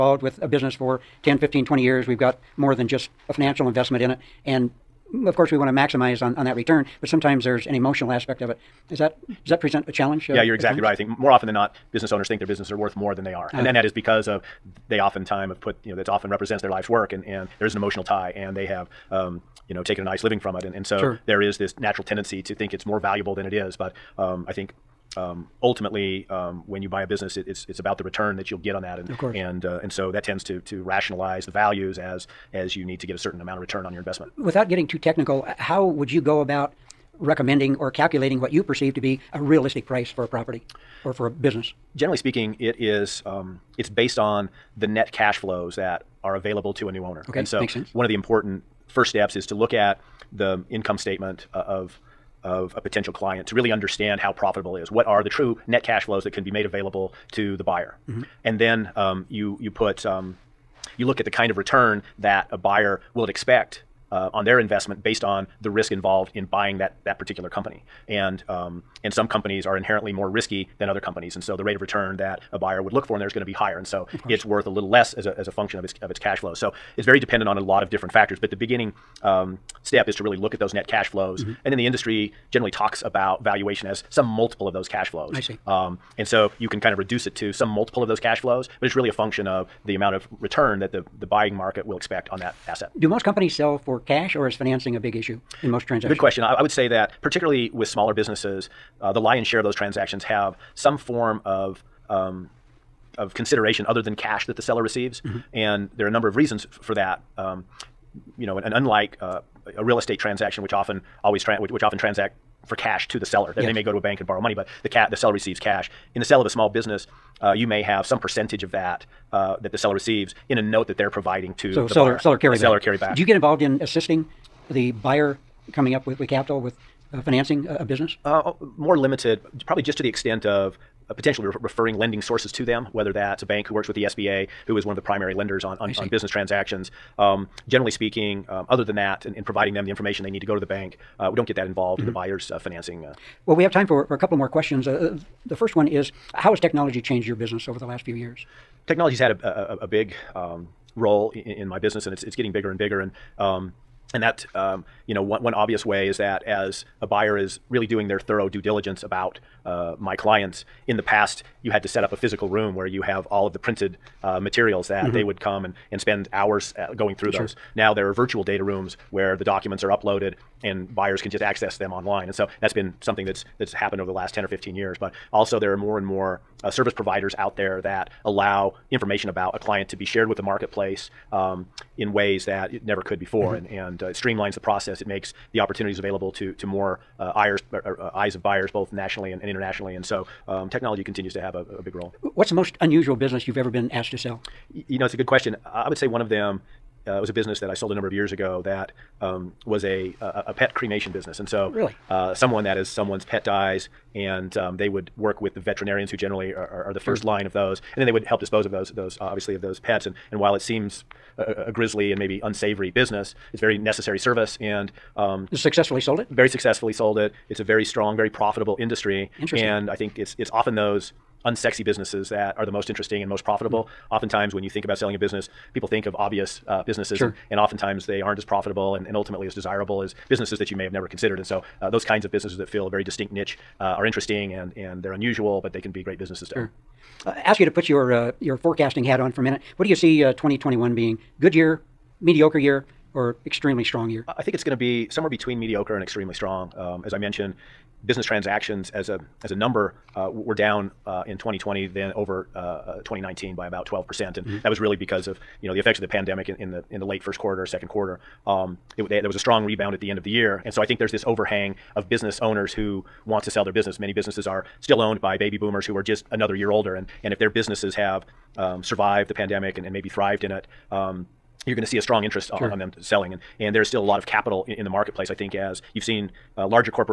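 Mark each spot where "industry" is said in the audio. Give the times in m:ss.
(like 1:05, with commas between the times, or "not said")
1:21, 3:38.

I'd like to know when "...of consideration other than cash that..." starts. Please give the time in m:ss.
1:43.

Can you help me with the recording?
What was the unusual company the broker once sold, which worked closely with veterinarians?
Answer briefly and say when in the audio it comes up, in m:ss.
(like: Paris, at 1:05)
Pet cremation business, at 3:20.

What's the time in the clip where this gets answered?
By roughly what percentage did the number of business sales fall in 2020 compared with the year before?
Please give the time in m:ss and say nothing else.
4:13.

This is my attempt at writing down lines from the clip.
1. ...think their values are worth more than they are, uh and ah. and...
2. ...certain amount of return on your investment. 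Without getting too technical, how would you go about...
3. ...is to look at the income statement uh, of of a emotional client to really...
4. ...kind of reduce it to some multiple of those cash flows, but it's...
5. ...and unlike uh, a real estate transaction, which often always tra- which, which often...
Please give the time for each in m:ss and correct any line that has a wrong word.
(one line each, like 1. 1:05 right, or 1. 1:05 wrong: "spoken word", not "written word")
1. 0:12 wrong: "businesses", not "values"
2. 0:33 right
3. 0:49 wrong: "potential", not "emotional"
4. 1:26 right
5. 1:48 right.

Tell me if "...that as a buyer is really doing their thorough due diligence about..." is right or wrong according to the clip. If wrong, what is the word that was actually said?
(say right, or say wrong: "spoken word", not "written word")
right.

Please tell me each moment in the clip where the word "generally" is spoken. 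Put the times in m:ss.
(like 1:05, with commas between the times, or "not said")
0:41, 1:22, 2:17, 3:26.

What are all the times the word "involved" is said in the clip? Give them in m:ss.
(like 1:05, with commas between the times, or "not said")
1:05, 2:03, 2:21.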